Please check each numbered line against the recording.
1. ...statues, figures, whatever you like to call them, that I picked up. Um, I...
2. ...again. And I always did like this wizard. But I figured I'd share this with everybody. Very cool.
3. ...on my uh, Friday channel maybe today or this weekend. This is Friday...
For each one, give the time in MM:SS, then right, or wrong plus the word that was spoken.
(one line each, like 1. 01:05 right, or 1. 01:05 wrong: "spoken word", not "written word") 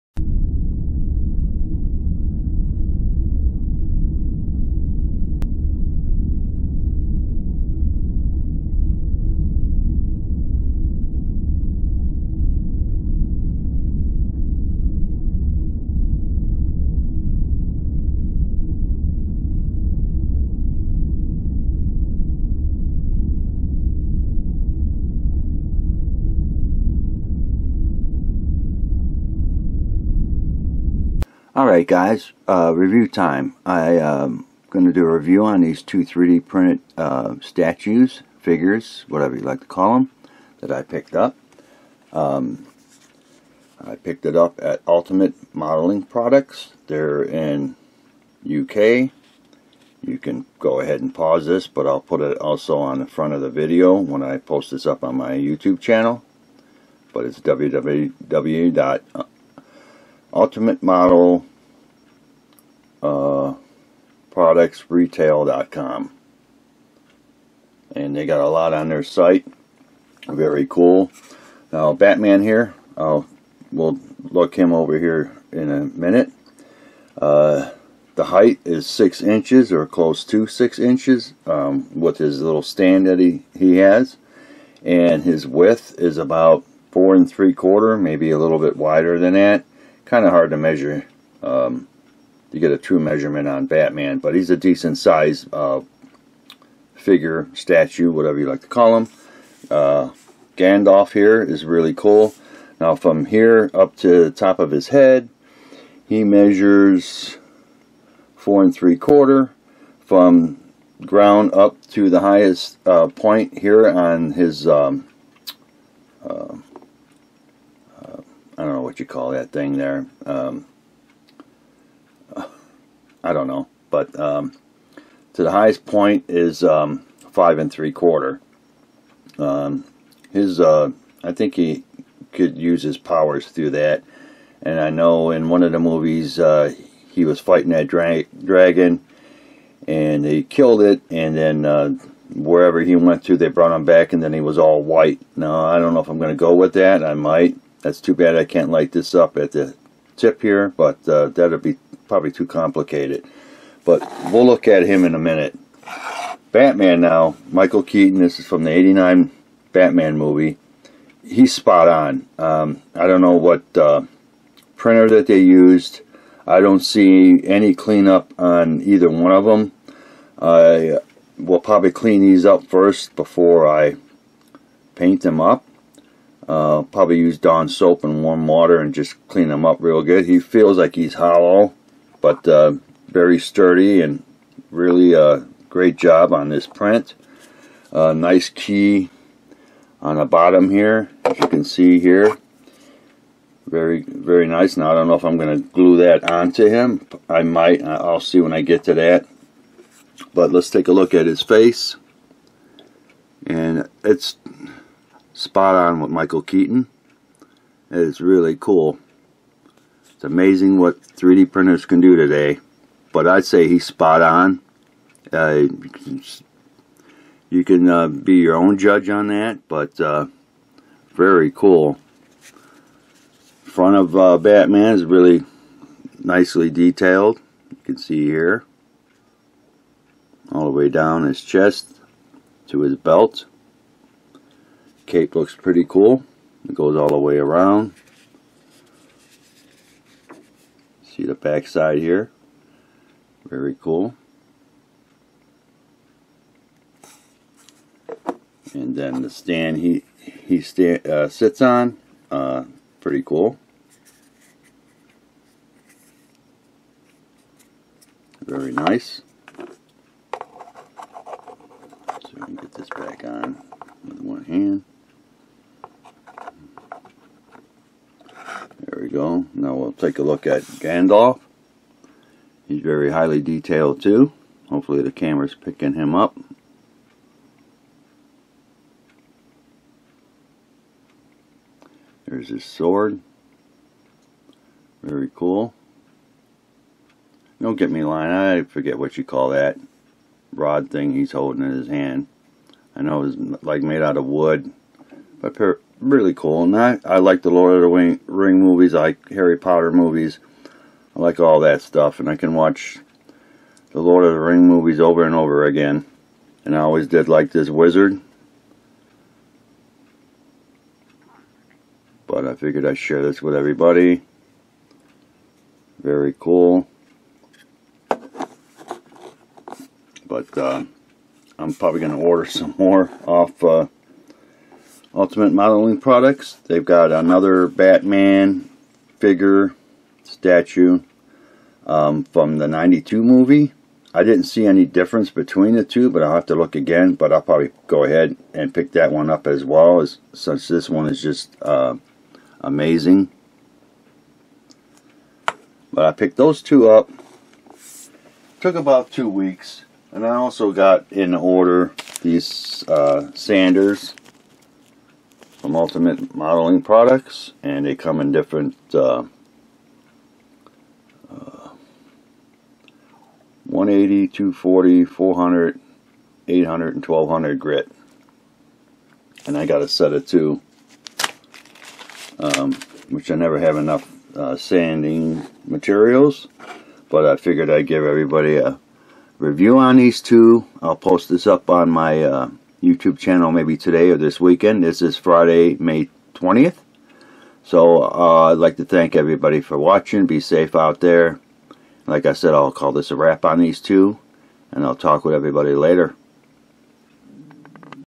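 1. 00:37 right
2. 05:05 right
3. 06:21 wrong: "YouTube", not "Friday".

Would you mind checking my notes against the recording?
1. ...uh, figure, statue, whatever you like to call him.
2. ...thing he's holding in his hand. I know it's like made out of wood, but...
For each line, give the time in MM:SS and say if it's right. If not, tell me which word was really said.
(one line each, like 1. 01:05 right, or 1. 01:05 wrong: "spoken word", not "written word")
1. 01:35 right
2. 04:50 right.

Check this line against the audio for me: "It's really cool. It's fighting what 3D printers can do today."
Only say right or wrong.
wrong.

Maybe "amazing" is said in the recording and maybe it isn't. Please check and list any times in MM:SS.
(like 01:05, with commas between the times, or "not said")
03:30, 05:42.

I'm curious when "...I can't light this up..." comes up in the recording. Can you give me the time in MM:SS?
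02:28.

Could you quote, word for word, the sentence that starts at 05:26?
They've got another Batman figure statue um, from the 92 movie.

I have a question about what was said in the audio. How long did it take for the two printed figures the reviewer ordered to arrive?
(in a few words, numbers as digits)
About two weeks.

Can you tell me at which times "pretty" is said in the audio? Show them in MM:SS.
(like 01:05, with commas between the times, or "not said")
03:55, 04:13.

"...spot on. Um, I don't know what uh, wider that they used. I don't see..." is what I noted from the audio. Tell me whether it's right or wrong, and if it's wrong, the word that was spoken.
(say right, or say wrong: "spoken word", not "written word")
wrong: "printer", not "wider".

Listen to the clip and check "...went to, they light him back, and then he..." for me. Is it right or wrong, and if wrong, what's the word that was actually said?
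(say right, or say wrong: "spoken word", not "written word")
wrong: "brought", not "light".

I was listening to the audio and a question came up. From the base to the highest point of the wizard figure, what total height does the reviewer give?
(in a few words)
5 3/4 inches.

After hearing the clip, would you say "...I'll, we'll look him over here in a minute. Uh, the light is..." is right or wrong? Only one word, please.
wrong.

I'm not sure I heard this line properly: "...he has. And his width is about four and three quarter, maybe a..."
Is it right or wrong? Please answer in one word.
right.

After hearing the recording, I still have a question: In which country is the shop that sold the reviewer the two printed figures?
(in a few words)
UK.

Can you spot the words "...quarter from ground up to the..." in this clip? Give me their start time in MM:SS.
01:48.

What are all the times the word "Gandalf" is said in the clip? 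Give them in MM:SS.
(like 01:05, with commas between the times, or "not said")
01:40, 04:30.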